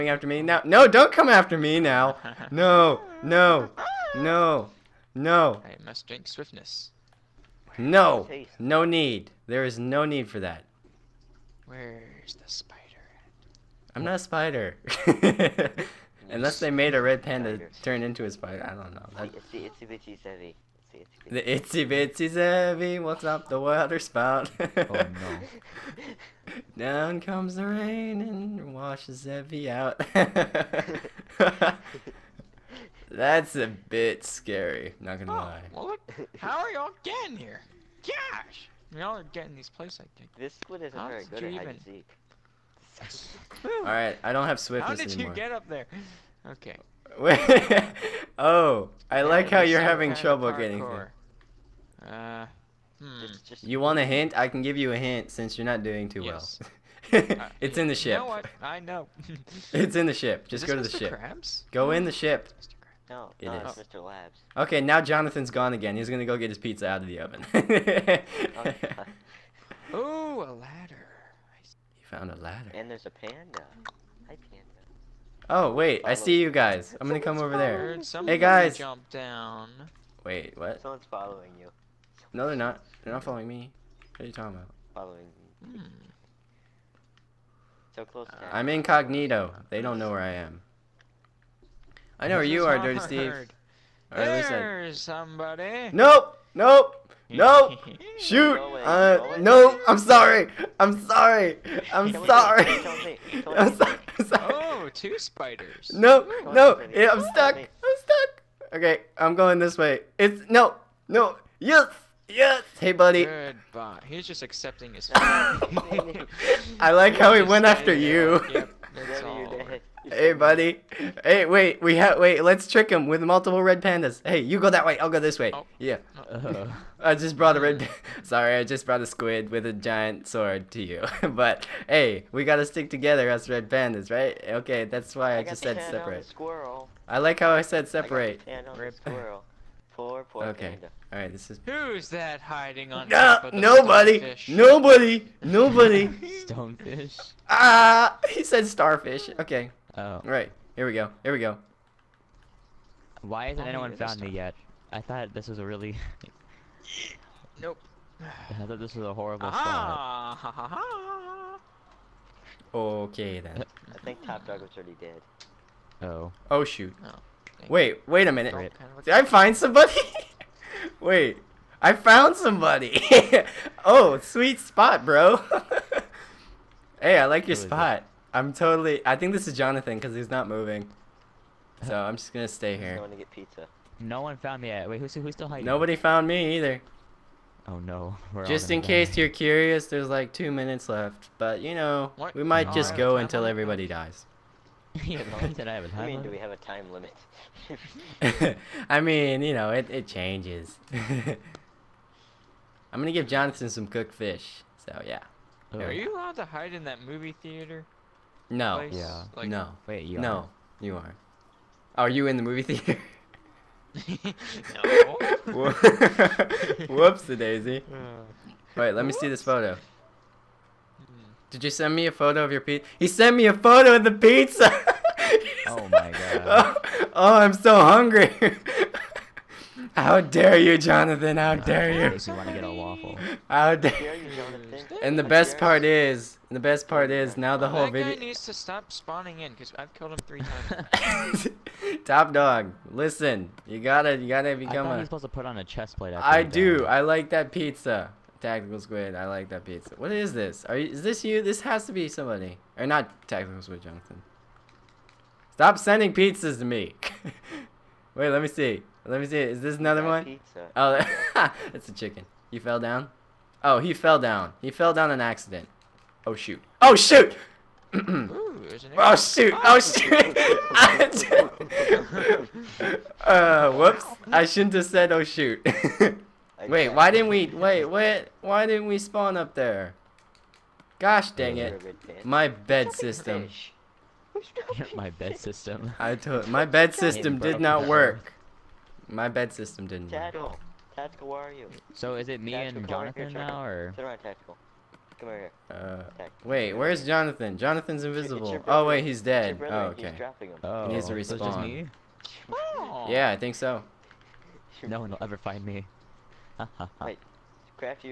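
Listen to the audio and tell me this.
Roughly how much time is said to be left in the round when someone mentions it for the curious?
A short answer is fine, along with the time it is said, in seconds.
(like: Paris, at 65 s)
2 minutes, at 190 s.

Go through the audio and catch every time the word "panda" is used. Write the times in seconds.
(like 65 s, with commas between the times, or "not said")
17 s, 73 s, 123 s, 133 s, 140 s.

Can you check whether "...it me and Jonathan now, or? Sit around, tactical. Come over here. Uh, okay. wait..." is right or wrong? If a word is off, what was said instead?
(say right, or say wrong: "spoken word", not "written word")
right.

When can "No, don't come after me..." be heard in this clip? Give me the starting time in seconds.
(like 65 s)
0 s.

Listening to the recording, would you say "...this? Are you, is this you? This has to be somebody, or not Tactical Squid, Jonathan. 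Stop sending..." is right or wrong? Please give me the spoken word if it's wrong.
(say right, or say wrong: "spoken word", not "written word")
right.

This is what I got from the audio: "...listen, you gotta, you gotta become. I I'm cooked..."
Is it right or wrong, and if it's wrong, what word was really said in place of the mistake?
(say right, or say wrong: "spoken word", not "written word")
wrong: "supposed", not "cooked".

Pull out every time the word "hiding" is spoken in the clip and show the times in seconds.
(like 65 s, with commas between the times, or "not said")
142 s, 185 s.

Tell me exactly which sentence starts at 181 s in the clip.
So I'm just gonna stay here.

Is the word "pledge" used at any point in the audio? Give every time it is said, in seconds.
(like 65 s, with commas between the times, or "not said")
not said.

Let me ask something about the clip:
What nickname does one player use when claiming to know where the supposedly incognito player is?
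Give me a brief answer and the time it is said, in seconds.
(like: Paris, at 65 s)
Dirty Steve, at 92 s.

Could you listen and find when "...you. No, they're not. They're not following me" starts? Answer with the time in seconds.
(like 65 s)
81 s.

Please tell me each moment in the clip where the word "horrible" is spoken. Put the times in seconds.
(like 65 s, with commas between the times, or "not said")
159 s.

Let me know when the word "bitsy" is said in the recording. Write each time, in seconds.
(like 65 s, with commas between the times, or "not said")
21 s.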